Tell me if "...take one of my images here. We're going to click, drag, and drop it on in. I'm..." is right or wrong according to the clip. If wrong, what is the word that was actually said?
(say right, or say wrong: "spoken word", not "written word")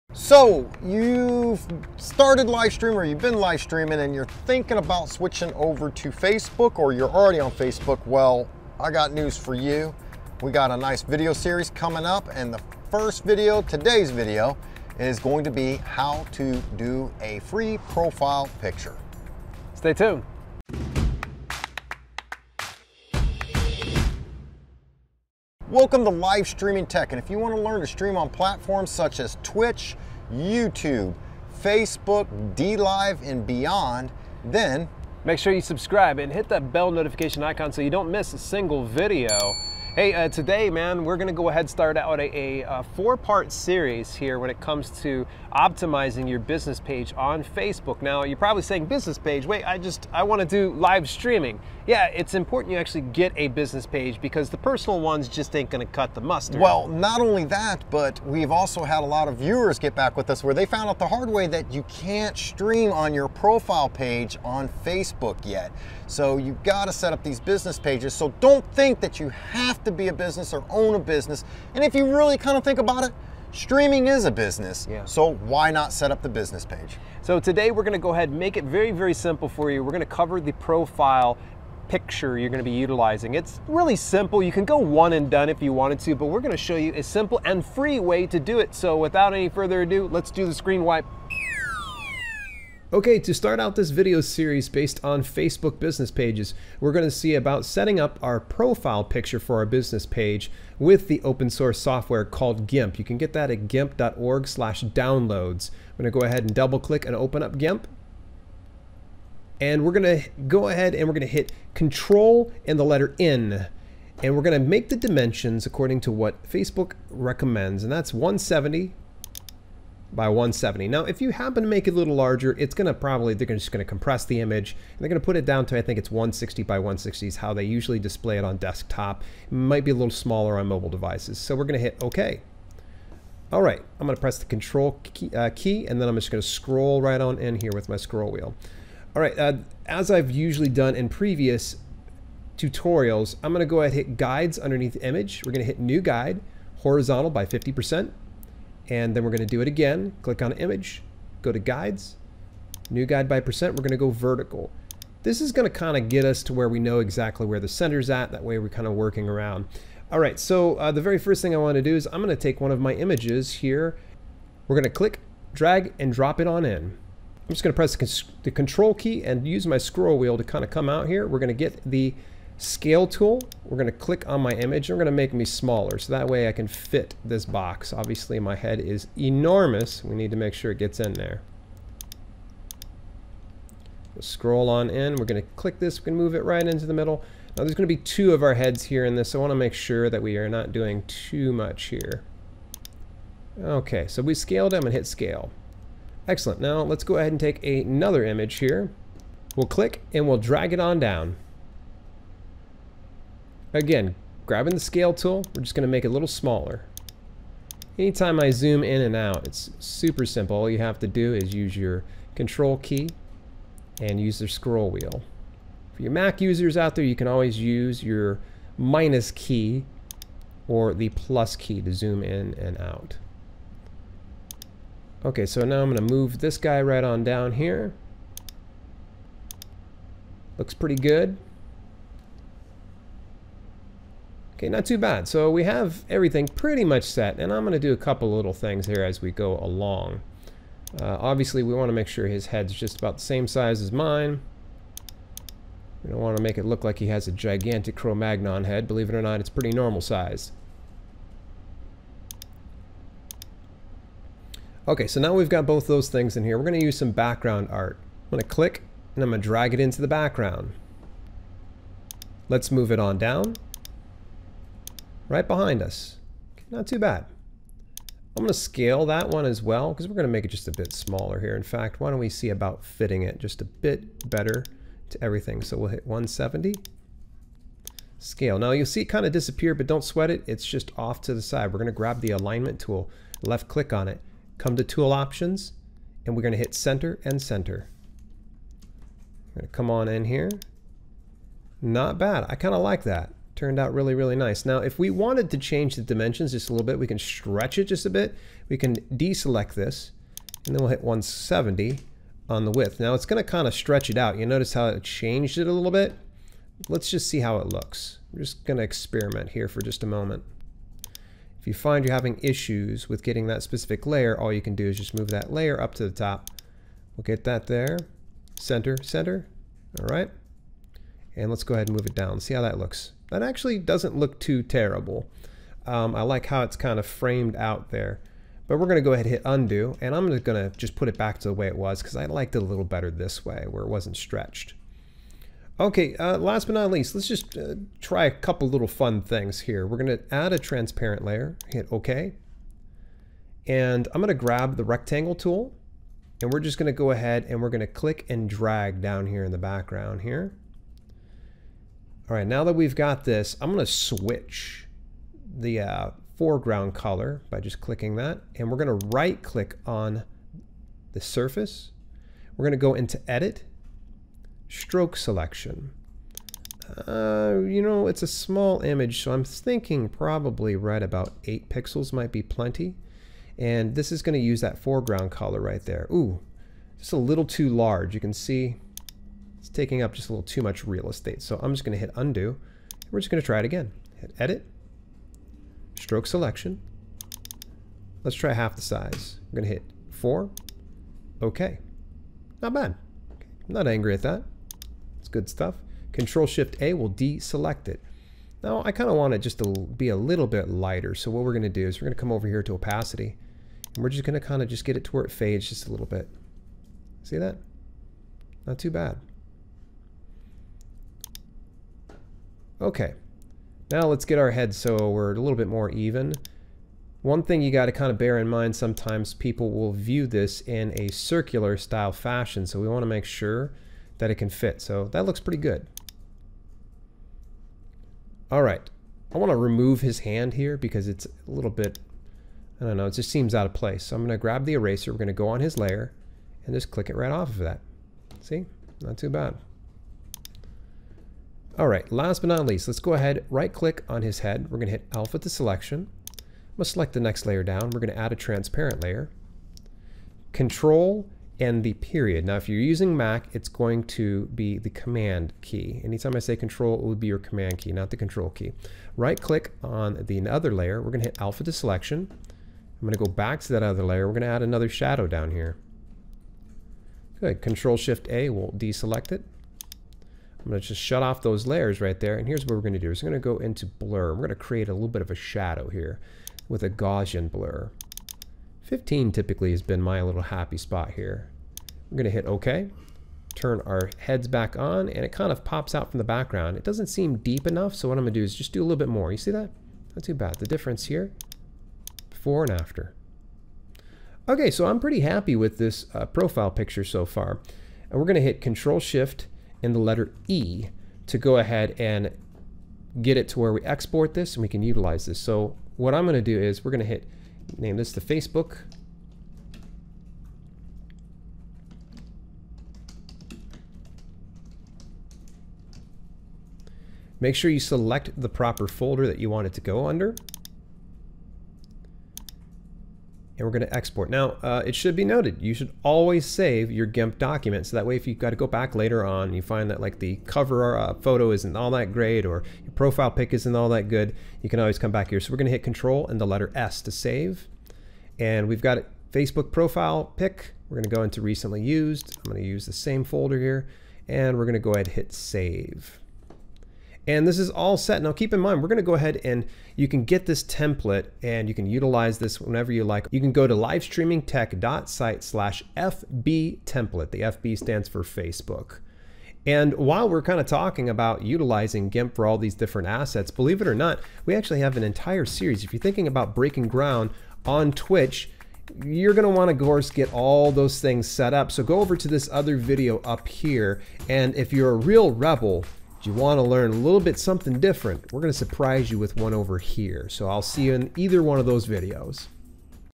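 right.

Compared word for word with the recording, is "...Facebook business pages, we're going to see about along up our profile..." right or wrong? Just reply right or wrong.
wrong.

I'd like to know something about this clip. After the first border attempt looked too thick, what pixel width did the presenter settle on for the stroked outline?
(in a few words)
4.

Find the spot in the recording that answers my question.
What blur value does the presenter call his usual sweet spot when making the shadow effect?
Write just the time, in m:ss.
7:58.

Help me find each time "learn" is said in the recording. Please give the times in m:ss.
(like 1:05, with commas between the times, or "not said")
0:27, 9:36.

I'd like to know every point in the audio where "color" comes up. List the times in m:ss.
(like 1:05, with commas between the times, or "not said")
5:56, 6:15.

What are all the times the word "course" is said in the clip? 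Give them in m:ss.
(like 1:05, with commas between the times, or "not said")
9:29.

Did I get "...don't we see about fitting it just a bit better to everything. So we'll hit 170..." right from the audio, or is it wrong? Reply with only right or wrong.
right.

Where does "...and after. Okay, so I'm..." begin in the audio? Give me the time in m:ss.
8:12.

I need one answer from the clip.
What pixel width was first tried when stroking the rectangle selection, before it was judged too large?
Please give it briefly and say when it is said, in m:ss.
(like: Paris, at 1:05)
8 pixels, at 6:11.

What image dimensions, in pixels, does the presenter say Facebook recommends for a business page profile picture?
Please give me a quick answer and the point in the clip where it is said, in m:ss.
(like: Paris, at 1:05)
170 by 170, at 1:58.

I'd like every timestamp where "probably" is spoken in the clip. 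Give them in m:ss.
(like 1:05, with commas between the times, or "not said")
0:48, 2:02, 6:10.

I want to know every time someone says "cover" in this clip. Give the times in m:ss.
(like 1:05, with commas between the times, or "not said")
1:20, 8:50.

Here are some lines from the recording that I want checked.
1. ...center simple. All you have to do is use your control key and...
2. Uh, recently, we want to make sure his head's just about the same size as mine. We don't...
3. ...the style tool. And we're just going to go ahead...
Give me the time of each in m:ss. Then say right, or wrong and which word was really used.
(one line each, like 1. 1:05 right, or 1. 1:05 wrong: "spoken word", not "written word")
1. 3:29 wrong: "super", not "center"
2. 4:01 wrong: "obviously", not "recently"
3. 5:44 wrong: "rectangle", not "style".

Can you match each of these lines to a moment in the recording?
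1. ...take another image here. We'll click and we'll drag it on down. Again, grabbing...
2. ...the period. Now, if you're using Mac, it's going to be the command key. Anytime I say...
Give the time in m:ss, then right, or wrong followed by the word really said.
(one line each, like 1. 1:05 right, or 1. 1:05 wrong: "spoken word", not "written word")
1. 3:17 right
2. 7:31 right.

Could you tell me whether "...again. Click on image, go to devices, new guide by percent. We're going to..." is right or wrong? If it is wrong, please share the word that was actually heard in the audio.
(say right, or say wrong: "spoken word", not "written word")
wrong: "guides", not "devices".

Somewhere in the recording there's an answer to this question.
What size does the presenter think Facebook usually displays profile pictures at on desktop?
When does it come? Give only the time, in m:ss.
2:06.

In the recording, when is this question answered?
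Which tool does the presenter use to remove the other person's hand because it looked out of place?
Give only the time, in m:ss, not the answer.
7:14.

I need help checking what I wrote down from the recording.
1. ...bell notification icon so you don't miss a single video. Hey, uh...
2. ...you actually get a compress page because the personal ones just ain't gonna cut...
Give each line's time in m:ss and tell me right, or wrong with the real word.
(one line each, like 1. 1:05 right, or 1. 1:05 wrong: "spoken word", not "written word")
1. 0:36 right
2. 0:52 wrong: "business", not "compress".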